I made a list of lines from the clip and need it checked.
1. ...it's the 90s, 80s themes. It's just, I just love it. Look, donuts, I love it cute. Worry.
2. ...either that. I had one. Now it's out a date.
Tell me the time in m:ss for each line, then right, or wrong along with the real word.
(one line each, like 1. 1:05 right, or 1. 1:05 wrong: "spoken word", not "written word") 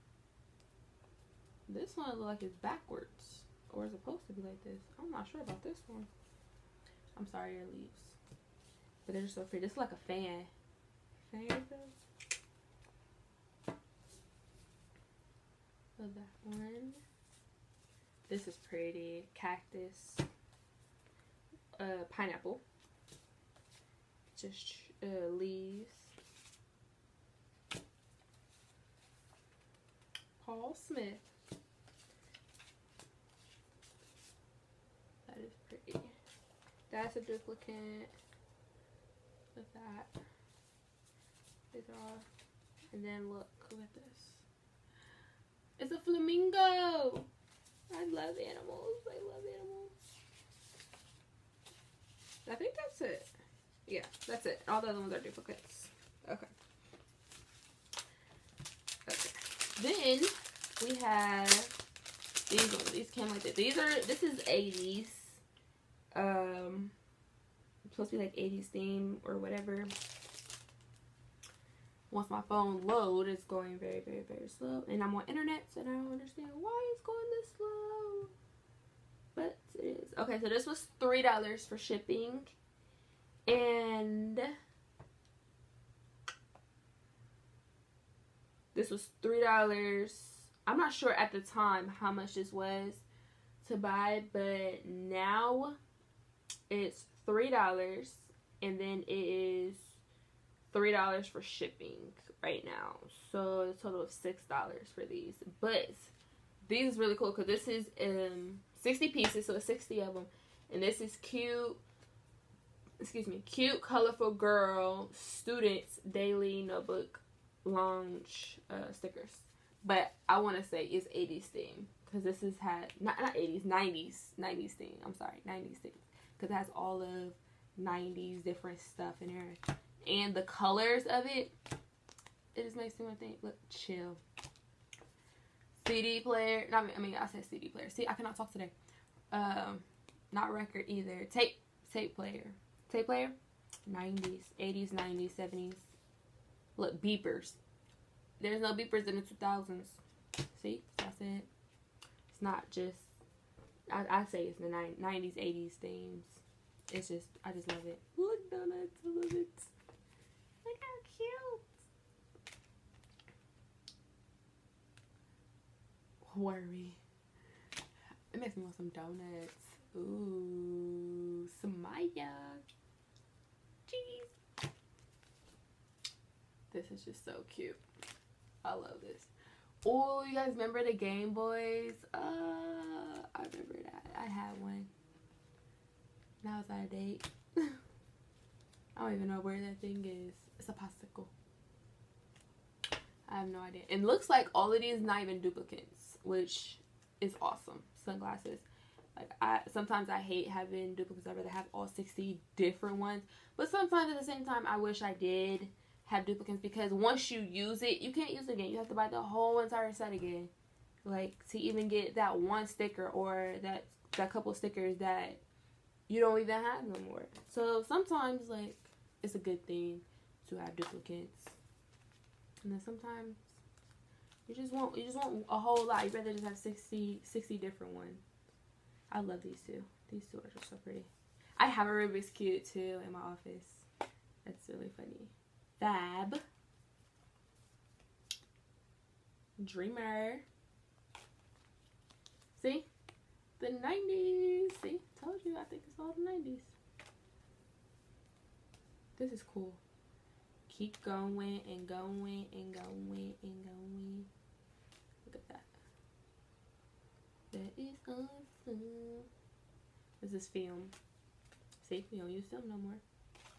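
1. 2:34 right
2. 3:03 wrong: "remember", not "either".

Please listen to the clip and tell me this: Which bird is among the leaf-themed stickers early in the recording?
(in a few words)
Flamingo.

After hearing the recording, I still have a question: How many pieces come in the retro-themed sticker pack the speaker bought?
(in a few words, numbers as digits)
60.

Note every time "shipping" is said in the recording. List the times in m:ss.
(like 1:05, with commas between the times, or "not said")
1:21, 1:41.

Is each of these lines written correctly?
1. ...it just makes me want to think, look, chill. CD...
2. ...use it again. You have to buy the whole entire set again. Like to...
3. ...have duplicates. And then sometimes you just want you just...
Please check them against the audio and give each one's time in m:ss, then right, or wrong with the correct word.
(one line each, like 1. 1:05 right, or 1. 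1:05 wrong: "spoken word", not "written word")
1. 2:12 right
2. 3:28 right
3. 3:40 right.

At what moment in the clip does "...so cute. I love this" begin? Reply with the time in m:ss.
2:57.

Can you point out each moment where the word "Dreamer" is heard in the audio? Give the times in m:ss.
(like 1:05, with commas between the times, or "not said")
3:59.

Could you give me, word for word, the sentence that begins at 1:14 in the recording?
And I'm on internet, so I don't understand why it's going this slow.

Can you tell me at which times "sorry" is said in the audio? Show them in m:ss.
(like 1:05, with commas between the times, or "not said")
0:07, 2:05.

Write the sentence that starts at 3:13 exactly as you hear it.
It looks like all of these not even duplicates, which is awesome.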